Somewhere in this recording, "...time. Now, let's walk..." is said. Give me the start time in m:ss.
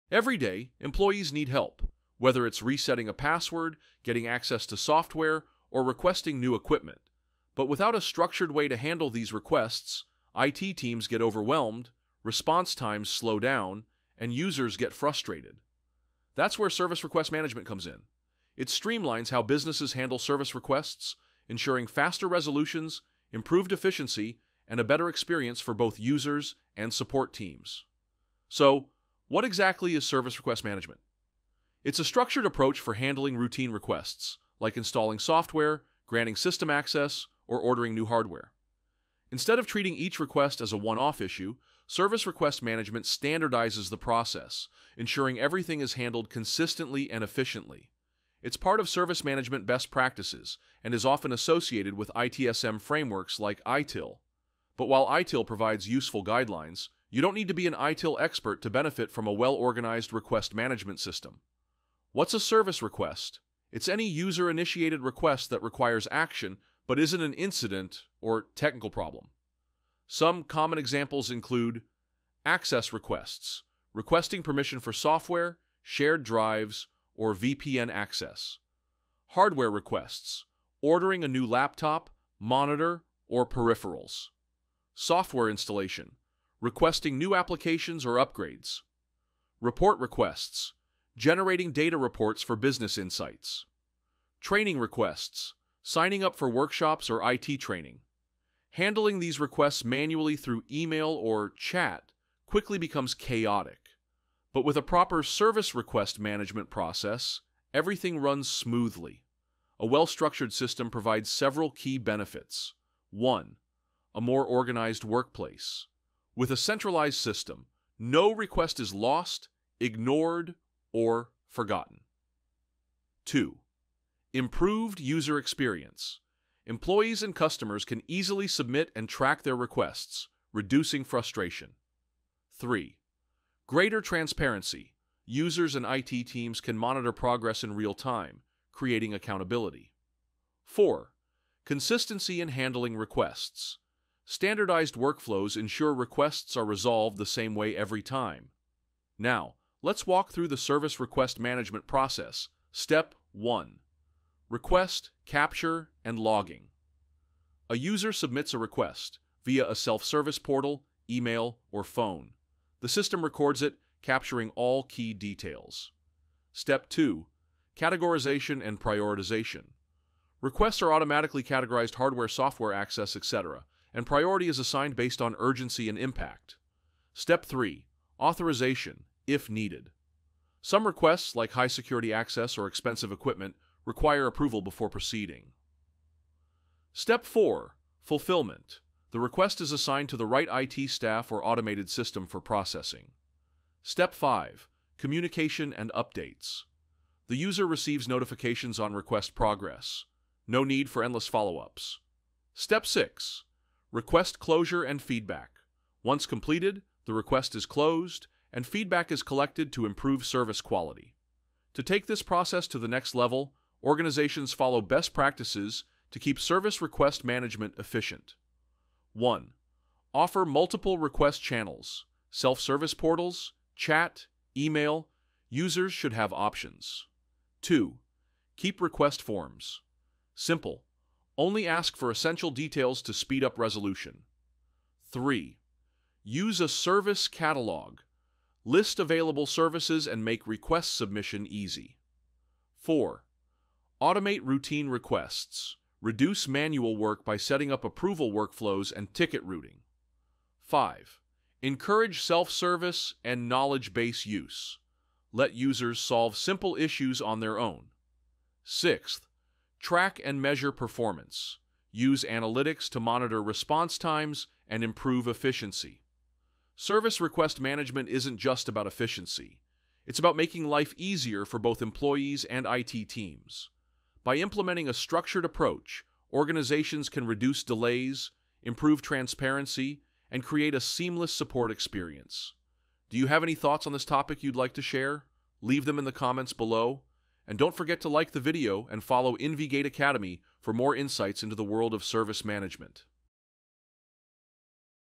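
2:28.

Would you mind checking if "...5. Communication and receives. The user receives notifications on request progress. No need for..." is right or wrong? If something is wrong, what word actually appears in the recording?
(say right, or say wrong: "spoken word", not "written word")
wrong: "updates", not "receives".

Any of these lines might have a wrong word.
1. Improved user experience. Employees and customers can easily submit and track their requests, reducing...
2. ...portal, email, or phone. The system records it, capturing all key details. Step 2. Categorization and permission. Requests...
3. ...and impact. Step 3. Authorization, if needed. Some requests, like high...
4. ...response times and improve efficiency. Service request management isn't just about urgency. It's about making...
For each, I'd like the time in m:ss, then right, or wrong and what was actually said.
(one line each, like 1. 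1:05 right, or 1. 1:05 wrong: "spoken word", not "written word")
1. 2:04 right
2. 2:40 wrong: "prioritization", not "permission"
3. 2:55 right
4. 4:23 wrong: "efficiency", not "urgency".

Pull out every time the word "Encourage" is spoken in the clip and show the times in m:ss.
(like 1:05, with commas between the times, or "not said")
4:11.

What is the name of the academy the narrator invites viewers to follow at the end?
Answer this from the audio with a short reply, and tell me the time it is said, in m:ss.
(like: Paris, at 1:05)
InvGate Academy, at 4:49.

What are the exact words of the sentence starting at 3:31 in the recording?
To take this process to the next level, organizations follow best practices to keep service request management efficient.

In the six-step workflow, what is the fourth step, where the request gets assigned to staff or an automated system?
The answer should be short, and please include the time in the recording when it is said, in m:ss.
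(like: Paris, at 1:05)
Fulfillment, at 3:08.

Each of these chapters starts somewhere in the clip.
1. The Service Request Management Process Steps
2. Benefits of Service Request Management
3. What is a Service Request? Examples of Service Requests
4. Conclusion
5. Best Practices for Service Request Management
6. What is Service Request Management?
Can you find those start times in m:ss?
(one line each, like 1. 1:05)
1. 2:30
2. 1:53
3. 1:03
4. 4:29
5. 3:34
6. 0:31.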